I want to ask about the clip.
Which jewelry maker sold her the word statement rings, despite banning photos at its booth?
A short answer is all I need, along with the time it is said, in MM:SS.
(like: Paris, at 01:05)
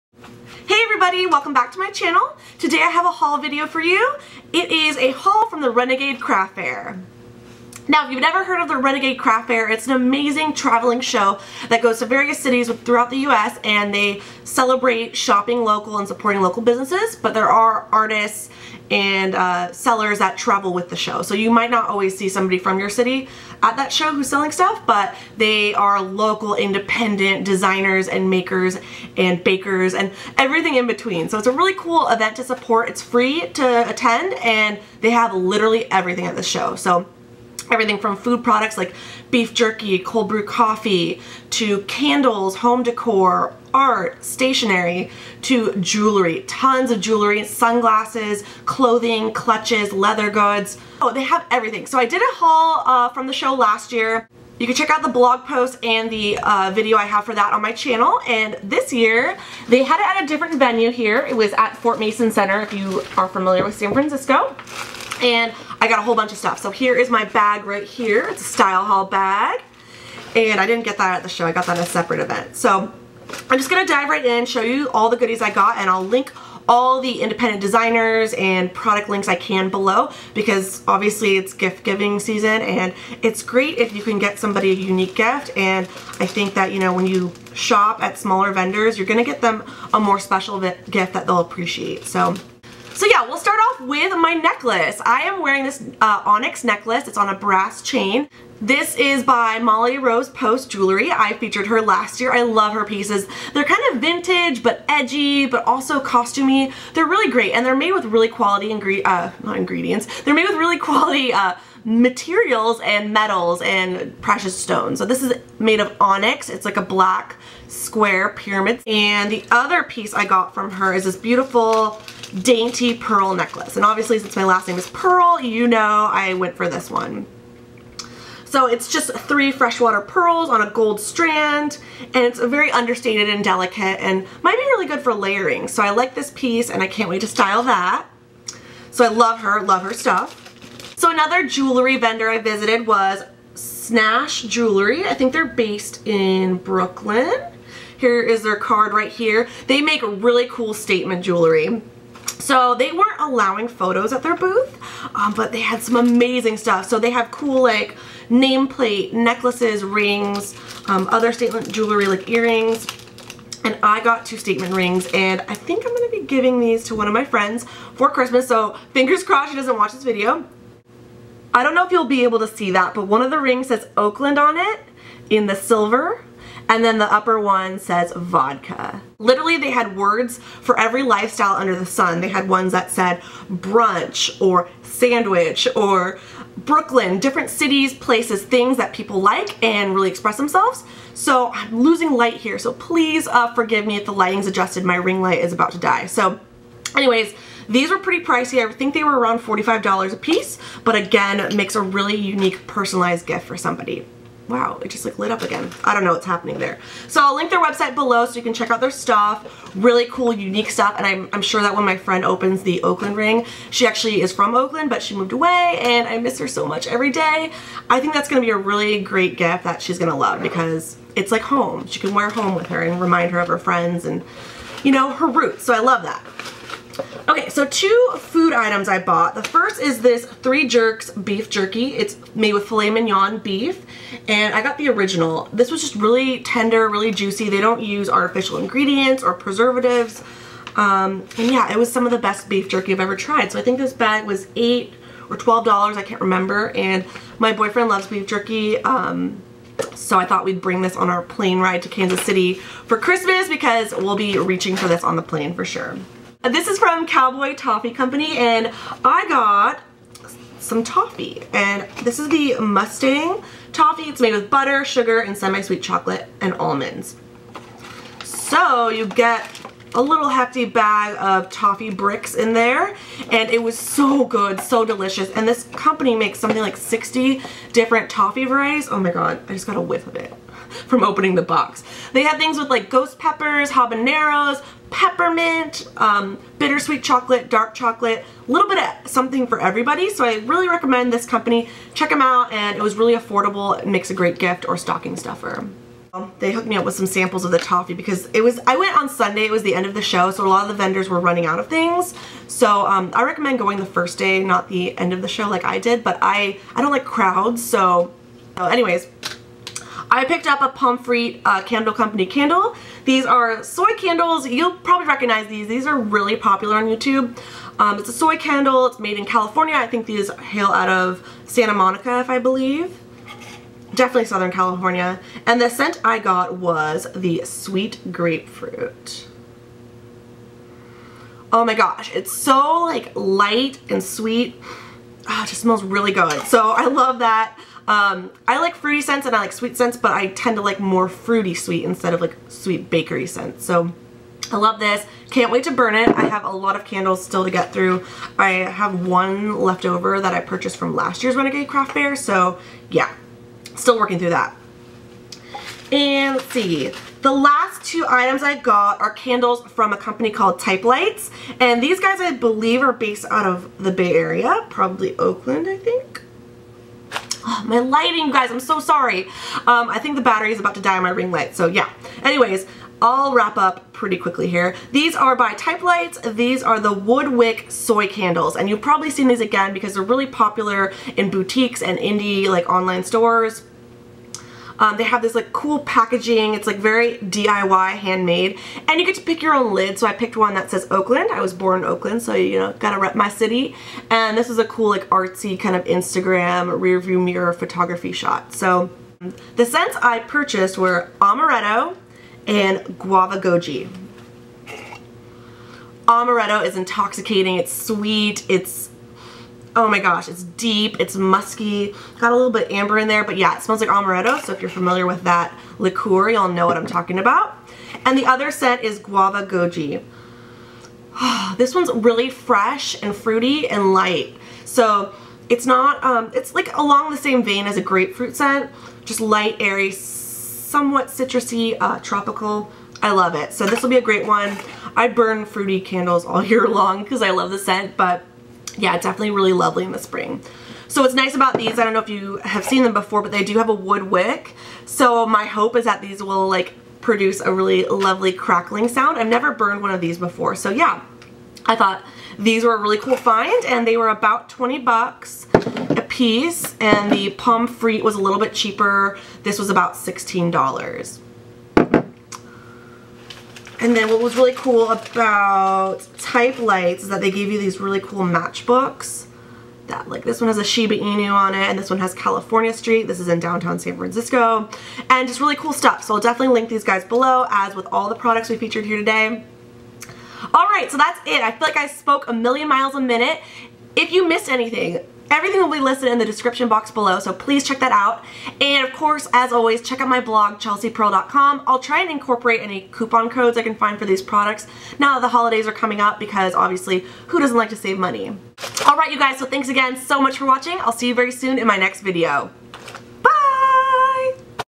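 Snash Jewelry, at 02:23.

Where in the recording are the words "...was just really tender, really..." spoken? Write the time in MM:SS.
03:55.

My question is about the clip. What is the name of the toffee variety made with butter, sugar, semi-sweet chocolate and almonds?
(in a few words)
Mustang.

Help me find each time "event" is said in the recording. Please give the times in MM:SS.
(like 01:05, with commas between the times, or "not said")
00:32, 01:12.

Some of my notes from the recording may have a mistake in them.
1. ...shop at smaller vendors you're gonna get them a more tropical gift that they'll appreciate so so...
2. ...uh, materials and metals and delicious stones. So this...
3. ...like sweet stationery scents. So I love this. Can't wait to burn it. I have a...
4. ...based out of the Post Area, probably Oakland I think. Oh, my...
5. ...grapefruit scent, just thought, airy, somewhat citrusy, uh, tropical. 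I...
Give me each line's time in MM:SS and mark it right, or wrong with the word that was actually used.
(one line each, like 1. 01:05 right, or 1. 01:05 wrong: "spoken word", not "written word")
1. 01:27 wrong: "special", not "tropical"
2. 01:51 wrong: "precious", not "delicious"
3. 05:42 wrong: "bakery", not "stationery"
4. 06:02 wrong: "Bay", not "Post"
5. 07:07 wrong: "light", not "thought".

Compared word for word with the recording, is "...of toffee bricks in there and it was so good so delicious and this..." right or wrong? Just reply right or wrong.
right.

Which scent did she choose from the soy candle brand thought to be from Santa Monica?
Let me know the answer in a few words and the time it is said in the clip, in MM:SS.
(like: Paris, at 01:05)
Sweet Grapefruit, at 05:27.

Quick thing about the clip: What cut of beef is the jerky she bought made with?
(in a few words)
Filet mignon.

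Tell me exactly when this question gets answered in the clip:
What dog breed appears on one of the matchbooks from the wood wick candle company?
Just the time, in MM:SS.
07:50.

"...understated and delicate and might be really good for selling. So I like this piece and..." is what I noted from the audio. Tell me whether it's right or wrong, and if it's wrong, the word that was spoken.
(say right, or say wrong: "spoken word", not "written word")
wrong: "layering", not "selling".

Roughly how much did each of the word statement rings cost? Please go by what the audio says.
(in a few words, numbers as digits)
$45.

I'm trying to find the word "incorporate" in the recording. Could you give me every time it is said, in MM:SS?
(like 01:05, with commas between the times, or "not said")
08:12.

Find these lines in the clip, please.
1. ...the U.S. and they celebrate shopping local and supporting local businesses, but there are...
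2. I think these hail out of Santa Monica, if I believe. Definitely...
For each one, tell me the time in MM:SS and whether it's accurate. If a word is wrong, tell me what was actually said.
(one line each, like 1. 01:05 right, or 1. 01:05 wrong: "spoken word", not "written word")
1. 00:13 right
2. 05:19 right.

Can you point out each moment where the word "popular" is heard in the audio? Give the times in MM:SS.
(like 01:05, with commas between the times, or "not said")
05:16, 06:20.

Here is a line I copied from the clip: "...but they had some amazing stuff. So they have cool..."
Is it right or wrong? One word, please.
right.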